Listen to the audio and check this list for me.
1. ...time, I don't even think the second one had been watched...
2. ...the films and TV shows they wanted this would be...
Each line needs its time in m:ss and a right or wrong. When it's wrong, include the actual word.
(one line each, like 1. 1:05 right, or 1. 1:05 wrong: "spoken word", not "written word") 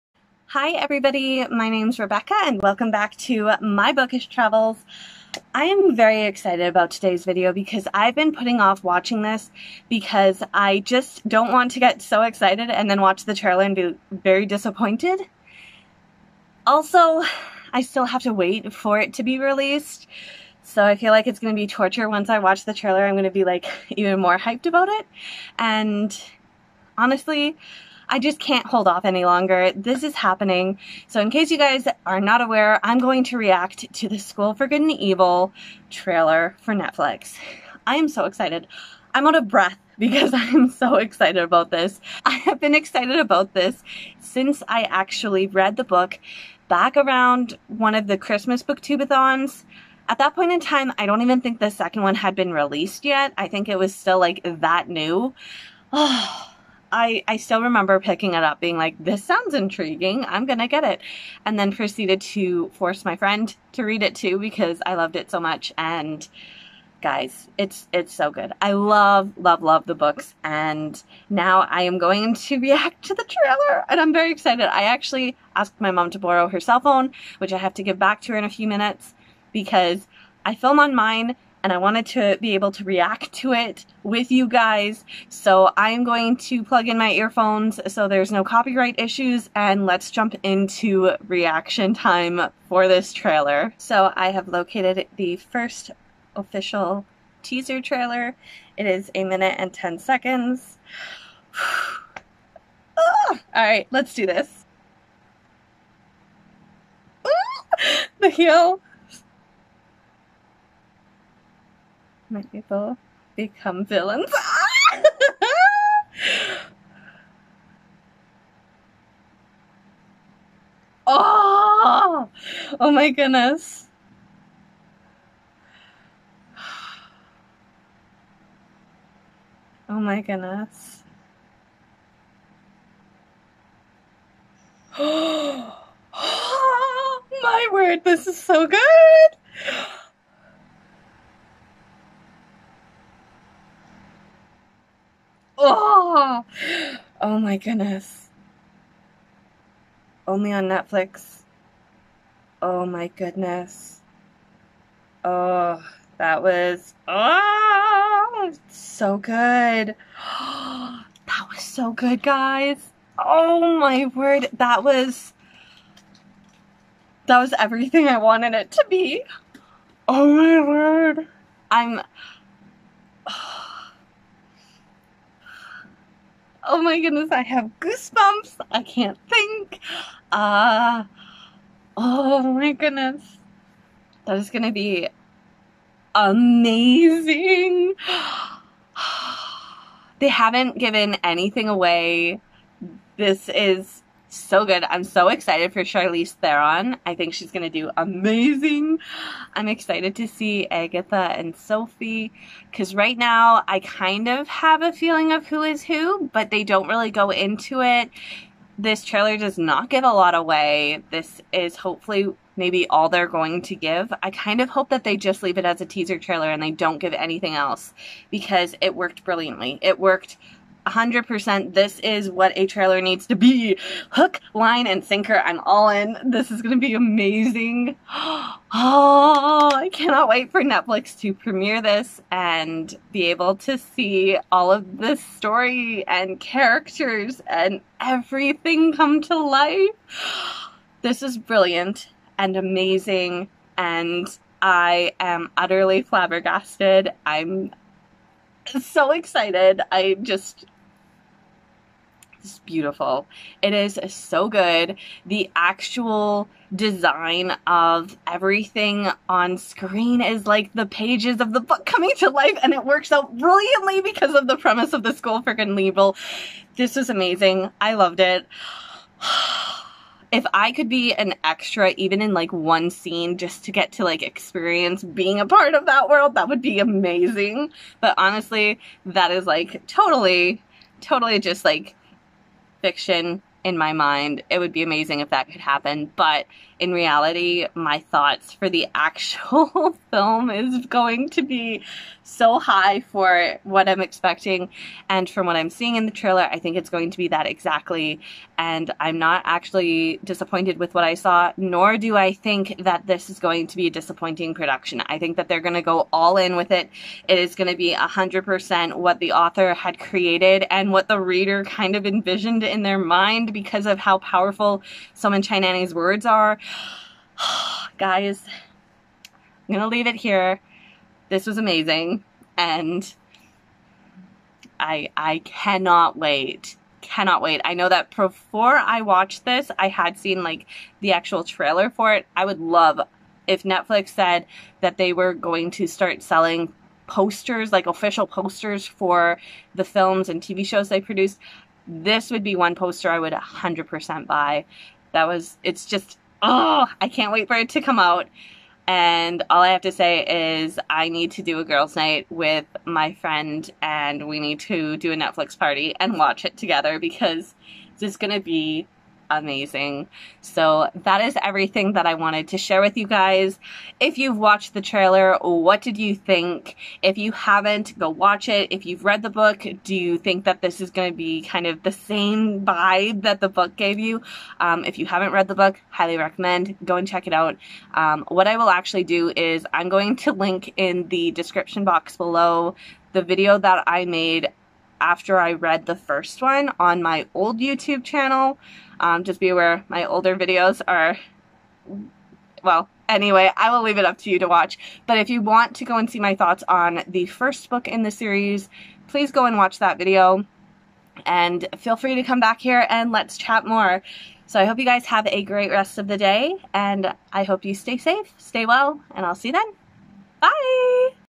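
1. 0:50 wrong: "released", not "watched"
2. 5:39 wrong: "produced", not "wanted".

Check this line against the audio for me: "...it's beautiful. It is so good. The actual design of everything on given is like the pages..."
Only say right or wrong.
wrong.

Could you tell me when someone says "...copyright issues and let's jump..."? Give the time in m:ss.
1:28.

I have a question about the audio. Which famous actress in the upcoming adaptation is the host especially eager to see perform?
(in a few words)
Charlize Theron.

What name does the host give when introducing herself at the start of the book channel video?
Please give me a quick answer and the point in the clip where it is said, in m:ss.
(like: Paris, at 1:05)
Rebecca, at 0:01.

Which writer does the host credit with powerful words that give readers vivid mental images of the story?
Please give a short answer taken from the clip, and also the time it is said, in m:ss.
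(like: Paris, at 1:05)
Soman Chainani, at 5:15.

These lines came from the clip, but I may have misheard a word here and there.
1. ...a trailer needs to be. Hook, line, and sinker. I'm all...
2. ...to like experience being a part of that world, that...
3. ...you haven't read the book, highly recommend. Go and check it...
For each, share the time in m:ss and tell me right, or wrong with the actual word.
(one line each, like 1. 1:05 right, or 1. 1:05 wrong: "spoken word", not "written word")
1. 3:42 right
2. 4:33 right
3. 6:14 right.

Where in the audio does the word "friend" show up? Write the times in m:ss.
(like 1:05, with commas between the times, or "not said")
1:03, 5:53.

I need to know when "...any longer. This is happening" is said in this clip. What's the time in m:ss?
0:29.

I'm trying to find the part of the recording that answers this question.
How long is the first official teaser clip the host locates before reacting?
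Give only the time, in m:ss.
1:39.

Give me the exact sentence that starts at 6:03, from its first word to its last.
If you've watched the trailer, what did you think?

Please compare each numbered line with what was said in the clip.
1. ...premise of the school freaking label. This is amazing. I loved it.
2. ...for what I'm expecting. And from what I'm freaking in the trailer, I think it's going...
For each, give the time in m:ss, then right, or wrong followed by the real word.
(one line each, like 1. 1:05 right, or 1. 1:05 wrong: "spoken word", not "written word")
1. 4:24 right
2. 4:53 wrong: "seeing", not "freaking".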